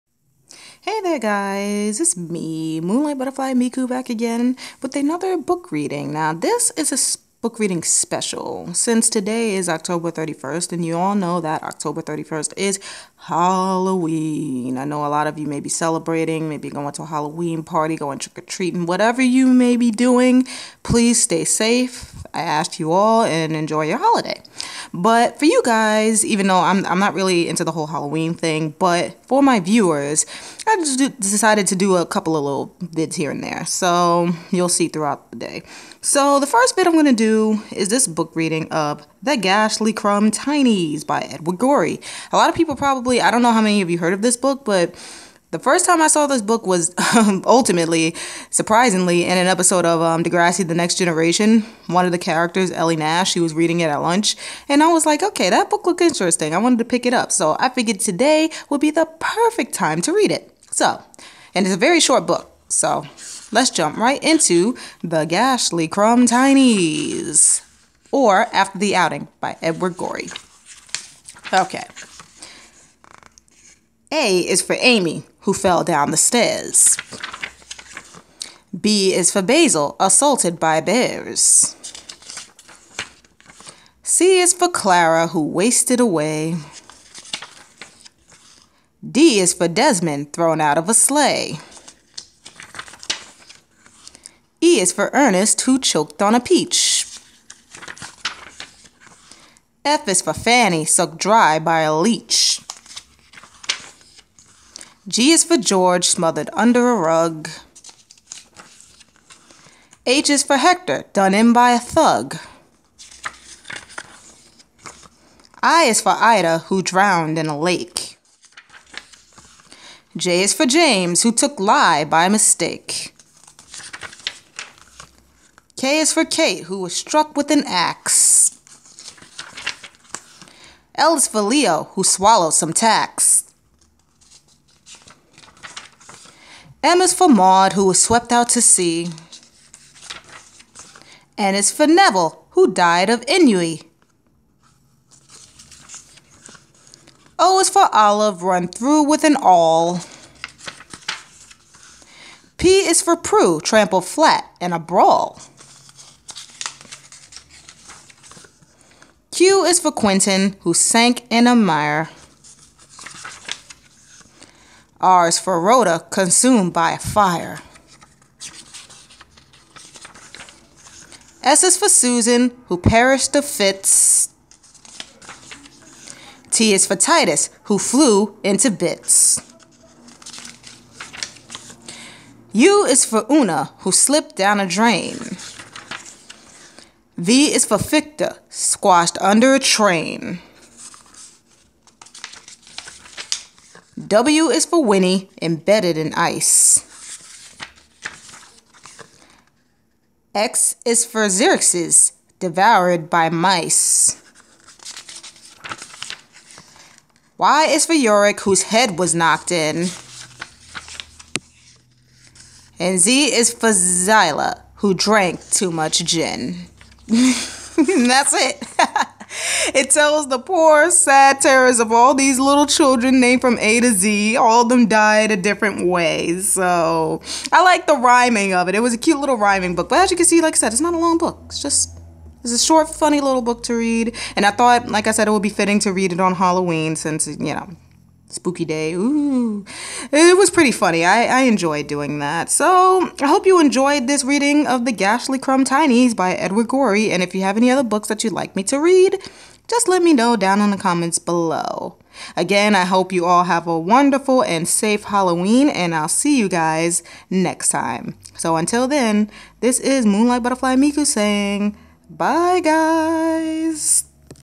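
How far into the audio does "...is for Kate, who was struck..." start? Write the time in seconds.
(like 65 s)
125 s.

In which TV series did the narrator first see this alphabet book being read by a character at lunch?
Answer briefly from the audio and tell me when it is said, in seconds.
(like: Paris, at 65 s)
Degrassi The Next Generation, at 50 s.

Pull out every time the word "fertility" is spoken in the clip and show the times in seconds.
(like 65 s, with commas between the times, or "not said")
not said.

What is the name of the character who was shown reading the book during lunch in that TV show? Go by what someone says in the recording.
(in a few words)
Ellie Nash.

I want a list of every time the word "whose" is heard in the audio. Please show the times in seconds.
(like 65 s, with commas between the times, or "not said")
208 s.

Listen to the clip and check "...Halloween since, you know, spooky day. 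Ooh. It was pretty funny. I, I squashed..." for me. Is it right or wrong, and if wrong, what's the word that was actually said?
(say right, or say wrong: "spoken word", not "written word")
wrong: "enjoyed", not "squashed".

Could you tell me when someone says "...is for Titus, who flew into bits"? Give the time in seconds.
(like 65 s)
176 s.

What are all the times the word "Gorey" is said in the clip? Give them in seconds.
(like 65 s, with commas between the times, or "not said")
41 s, 69 s, 246 s.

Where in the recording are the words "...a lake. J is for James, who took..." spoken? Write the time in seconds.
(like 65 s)
117 s.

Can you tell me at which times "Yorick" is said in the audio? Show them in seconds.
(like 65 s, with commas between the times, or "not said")
207 s.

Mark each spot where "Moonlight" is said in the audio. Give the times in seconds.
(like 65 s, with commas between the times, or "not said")
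2 s, 260 s.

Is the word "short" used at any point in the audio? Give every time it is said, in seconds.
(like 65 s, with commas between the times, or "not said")
61 s, 232 s.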